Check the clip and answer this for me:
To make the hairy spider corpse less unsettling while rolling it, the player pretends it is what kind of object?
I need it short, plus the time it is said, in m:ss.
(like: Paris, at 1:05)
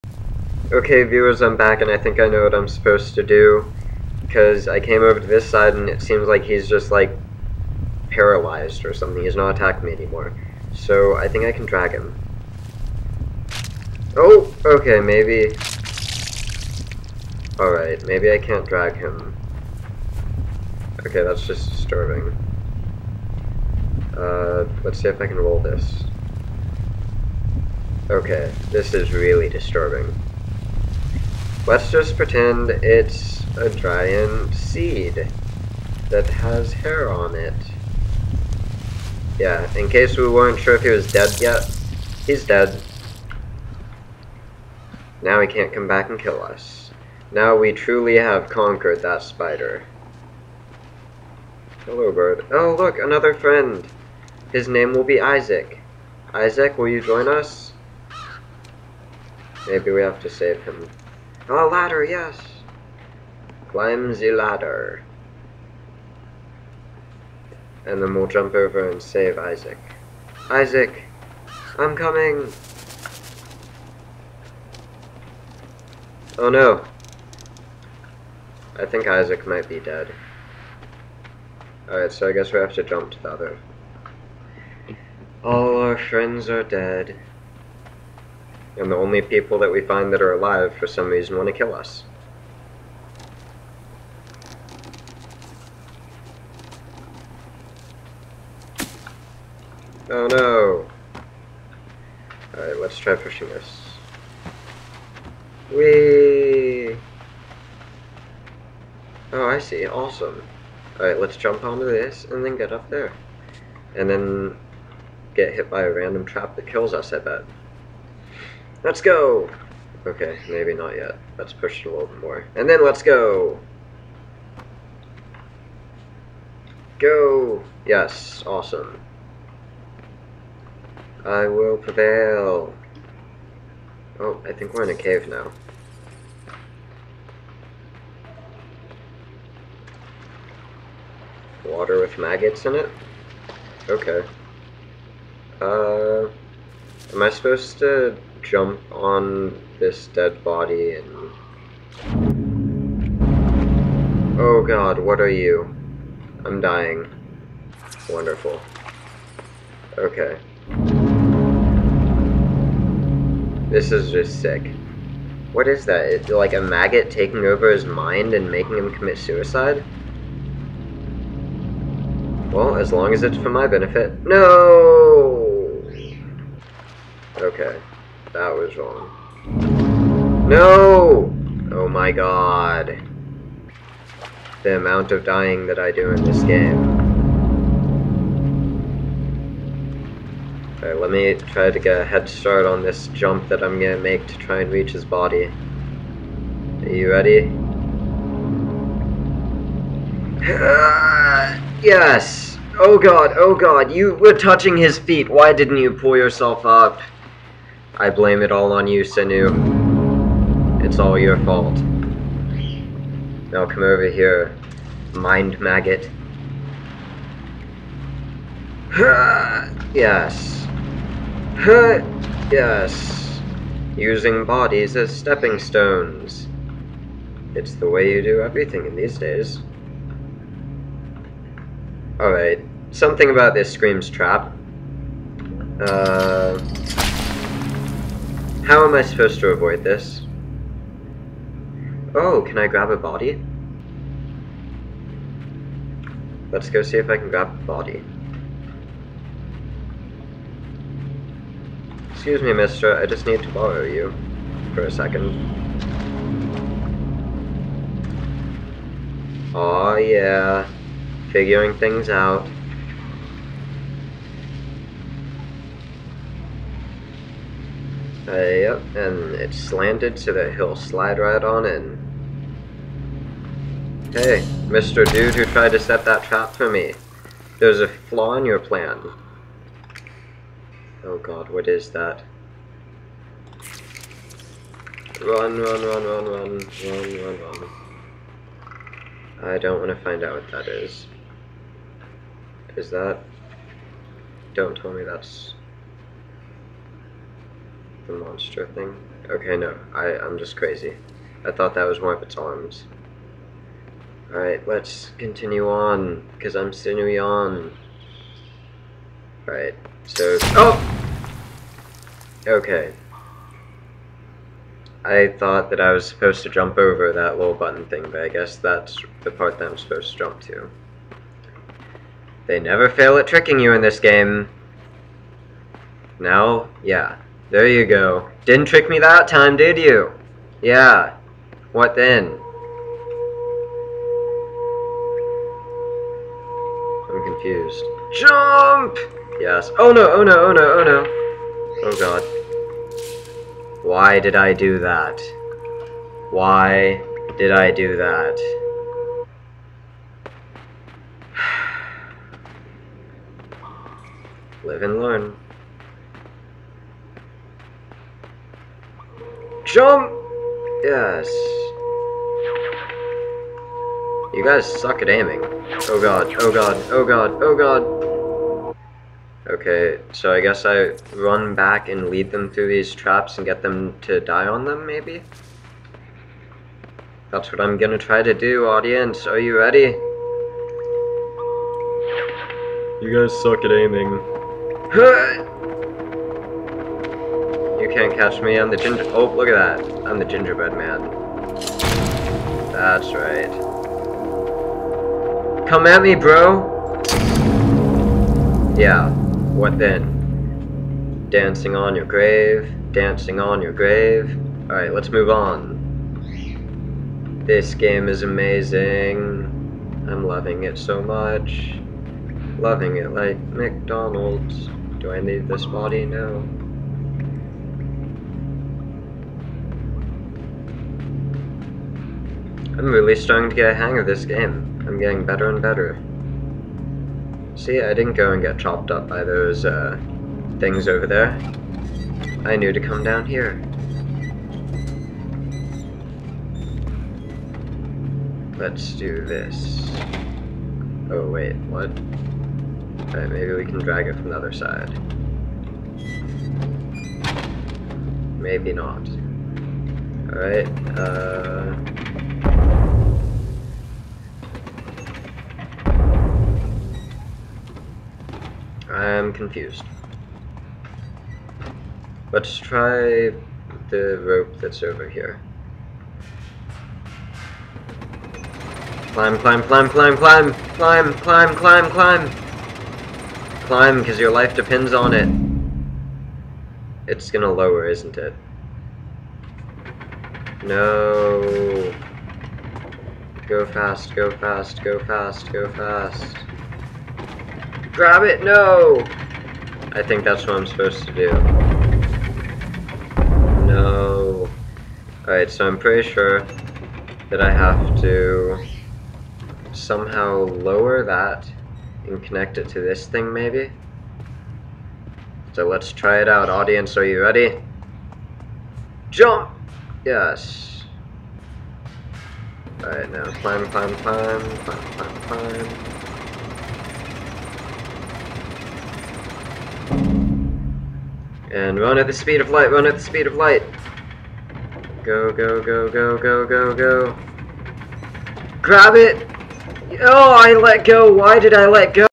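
A giant seed, at 0:33.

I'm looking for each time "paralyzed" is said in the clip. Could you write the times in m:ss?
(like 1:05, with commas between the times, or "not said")
0:08.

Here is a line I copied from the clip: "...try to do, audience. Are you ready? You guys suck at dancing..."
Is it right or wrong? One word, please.
wrong.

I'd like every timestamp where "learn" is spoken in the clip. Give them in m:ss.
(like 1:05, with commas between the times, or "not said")
5:55.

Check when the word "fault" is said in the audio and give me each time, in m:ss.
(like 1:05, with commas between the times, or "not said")
3:31.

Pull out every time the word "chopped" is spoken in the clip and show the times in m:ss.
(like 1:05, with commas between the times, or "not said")
7:08.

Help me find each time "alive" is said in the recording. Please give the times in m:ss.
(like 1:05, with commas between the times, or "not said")
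1:30.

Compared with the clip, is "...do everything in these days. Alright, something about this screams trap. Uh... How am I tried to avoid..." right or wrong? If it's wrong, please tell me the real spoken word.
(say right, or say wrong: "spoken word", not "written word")
wrong: "supposed", not "tried".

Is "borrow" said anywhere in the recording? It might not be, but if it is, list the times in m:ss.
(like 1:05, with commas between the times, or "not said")
4:13.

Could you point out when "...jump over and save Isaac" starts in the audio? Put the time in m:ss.
1:08.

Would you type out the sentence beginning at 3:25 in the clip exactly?
Why didn't you pull yourself up?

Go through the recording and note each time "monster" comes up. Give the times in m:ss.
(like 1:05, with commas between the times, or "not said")
4:58.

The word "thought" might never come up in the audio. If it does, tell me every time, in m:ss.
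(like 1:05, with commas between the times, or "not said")
5:01, 5:15.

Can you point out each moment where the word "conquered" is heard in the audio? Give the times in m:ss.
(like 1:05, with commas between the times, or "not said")
0:48.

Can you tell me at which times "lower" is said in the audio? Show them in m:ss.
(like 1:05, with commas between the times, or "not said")
7:57, 8:20.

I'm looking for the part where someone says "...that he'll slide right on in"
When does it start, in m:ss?
4:30.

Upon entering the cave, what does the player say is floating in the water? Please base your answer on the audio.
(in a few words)
Maggots.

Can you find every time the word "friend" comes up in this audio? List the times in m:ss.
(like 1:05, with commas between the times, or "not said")
0:53, 1:25.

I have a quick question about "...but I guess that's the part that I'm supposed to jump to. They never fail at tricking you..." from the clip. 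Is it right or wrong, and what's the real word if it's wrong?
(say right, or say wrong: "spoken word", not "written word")
right.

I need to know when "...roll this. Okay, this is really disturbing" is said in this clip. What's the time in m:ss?
0:25.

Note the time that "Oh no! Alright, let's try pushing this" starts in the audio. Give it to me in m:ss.
1:40.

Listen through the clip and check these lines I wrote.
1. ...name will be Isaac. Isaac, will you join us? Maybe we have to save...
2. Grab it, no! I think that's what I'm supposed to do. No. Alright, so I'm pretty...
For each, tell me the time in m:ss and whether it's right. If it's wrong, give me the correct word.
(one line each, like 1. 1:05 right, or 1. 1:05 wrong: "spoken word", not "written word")
1. 0:54 right
2. 8:07 right.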